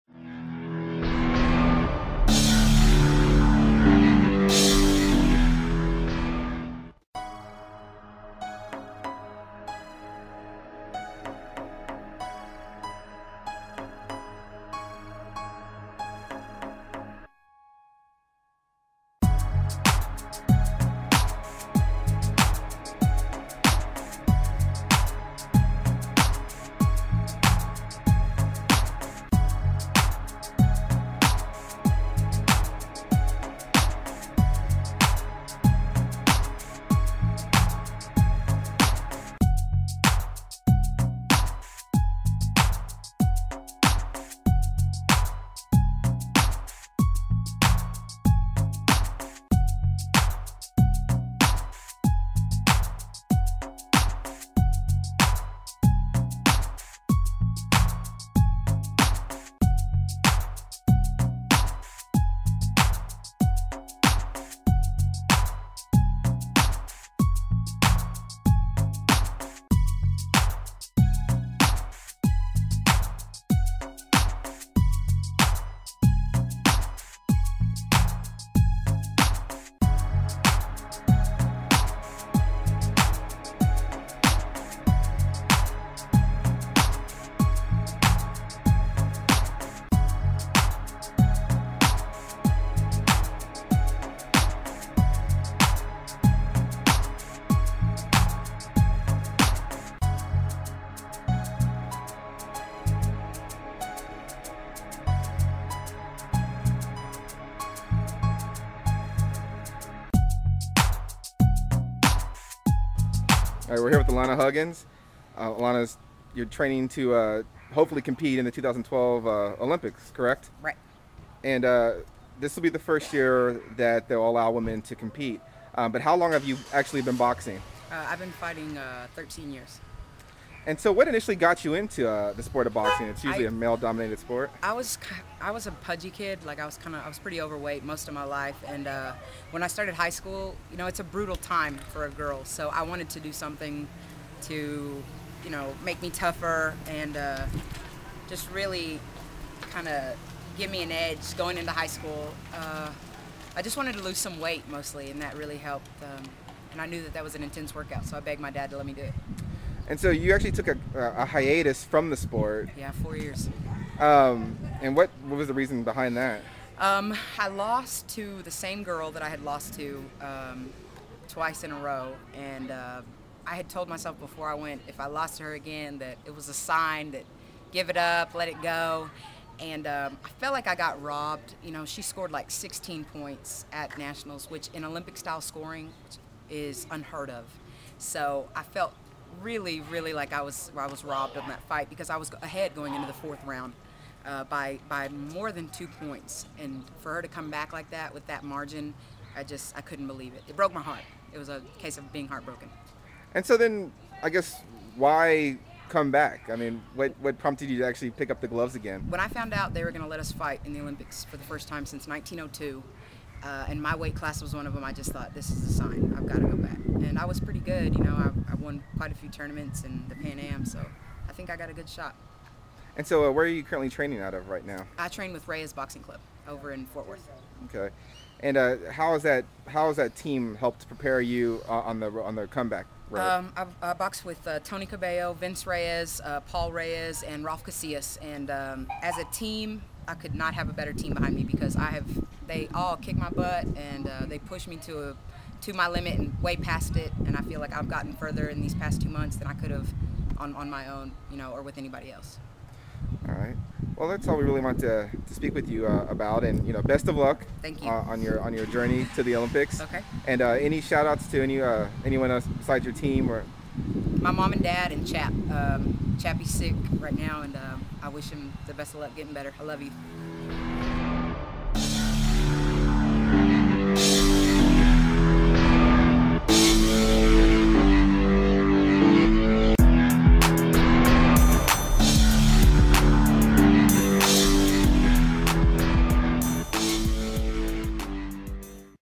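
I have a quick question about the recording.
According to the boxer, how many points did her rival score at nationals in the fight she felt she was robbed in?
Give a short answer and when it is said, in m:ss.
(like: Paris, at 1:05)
16, at 3:02.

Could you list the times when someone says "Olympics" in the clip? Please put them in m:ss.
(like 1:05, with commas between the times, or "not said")
1:59, 3:04, 3:30, 4:19.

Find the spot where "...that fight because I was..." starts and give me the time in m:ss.
3:11.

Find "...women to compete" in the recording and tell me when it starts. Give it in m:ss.
2:04.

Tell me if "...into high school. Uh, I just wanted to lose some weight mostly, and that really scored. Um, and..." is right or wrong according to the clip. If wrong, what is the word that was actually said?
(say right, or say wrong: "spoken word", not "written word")
wrong: "helped", not "scored".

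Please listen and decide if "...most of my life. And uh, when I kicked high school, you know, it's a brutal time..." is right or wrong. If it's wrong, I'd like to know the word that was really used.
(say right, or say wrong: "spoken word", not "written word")
wrong: "started", not "kicked".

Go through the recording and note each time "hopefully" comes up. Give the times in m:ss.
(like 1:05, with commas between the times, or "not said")
1:57.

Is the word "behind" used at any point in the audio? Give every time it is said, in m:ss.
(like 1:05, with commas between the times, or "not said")
2:45, 4:01.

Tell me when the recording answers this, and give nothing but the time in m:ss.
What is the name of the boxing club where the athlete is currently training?
3:45.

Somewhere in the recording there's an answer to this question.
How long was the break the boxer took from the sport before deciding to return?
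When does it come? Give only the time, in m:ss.
2:42.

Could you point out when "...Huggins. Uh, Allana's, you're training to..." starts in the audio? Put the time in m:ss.
1:54.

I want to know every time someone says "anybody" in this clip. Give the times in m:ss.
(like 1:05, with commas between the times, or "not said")
4:11.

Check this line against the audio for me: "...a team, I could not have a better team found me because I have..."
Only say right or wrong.
wrong.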